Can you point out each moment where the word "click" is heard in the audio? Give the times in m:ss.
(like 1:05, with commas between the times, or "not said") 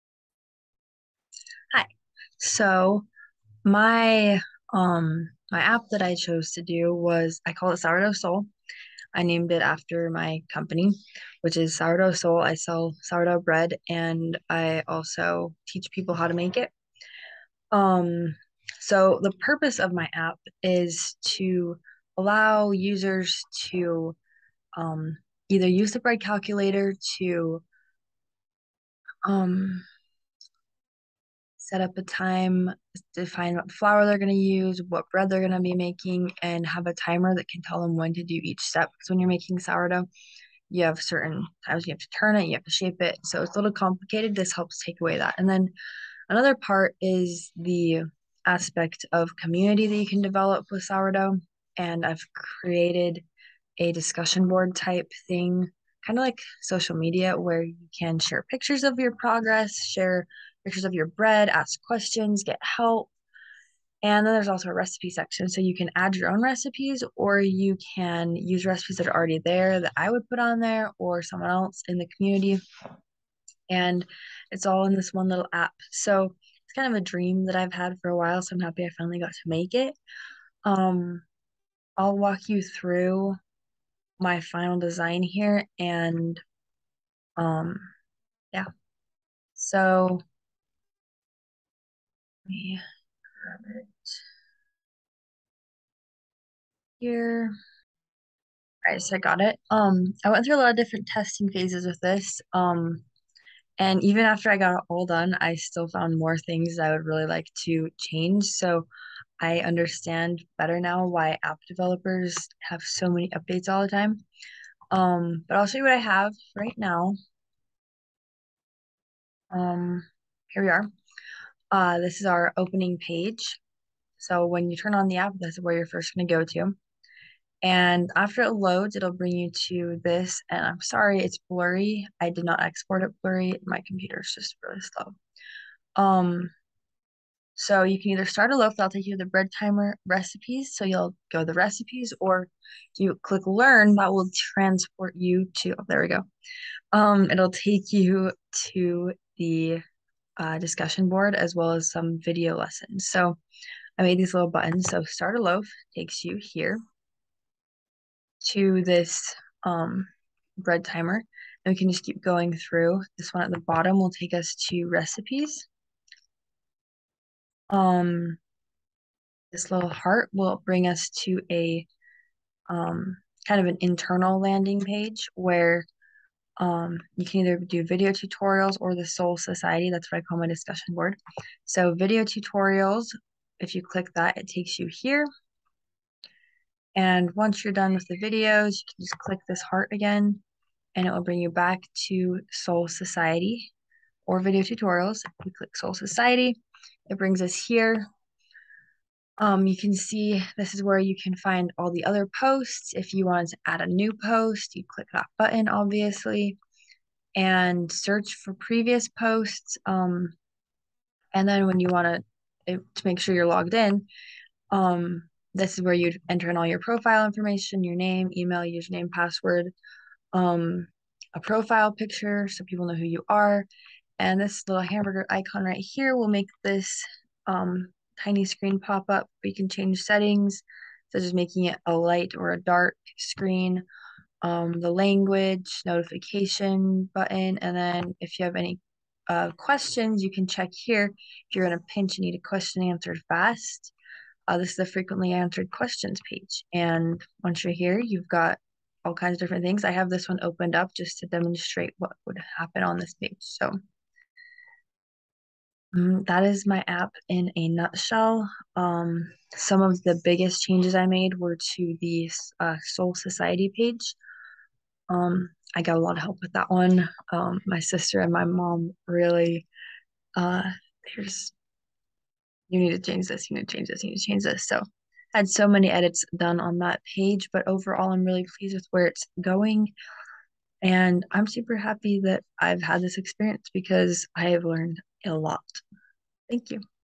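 2:23, 3:03, 3:09, 3:15, 3:24.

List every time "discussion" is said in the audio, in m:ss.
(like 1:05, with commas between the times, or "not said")
0:53, 2:30, 3:00.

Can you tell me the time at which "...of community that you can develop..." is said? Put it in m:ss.
0:49.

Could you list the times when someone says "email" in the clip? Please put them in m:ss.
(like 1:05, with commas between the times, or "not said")
3:38.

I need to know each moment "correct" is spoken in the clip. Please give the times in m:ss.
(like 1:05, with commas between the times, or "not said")
not said.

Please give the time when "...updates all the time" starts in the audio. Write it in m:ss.
1:53.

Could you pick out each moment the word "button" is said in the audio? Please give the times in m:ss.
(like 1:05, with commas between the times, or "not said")
2:34, 3:25, 3:57.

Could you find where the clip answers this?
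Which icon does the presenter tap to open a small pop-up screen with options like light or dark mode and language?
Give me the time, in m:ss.
3:44.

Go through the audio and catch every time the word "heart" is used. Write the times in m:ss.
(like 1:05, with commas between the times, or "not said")
2:49, 3:09.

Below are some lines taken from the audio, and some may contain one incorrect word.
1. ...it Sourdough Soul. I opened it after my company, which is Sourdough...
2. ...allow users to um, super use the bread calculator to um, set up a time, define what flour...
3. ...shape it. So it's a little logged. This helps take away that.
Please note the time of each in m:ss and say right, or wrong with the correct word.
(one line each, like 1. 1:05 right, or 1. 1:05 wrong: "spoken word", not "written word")
1. 0:07 wrong: "named", not "opened"
2. 0:22 wrong: "either", not "super"
3. 0:42 wrong: "complicated", not "logged".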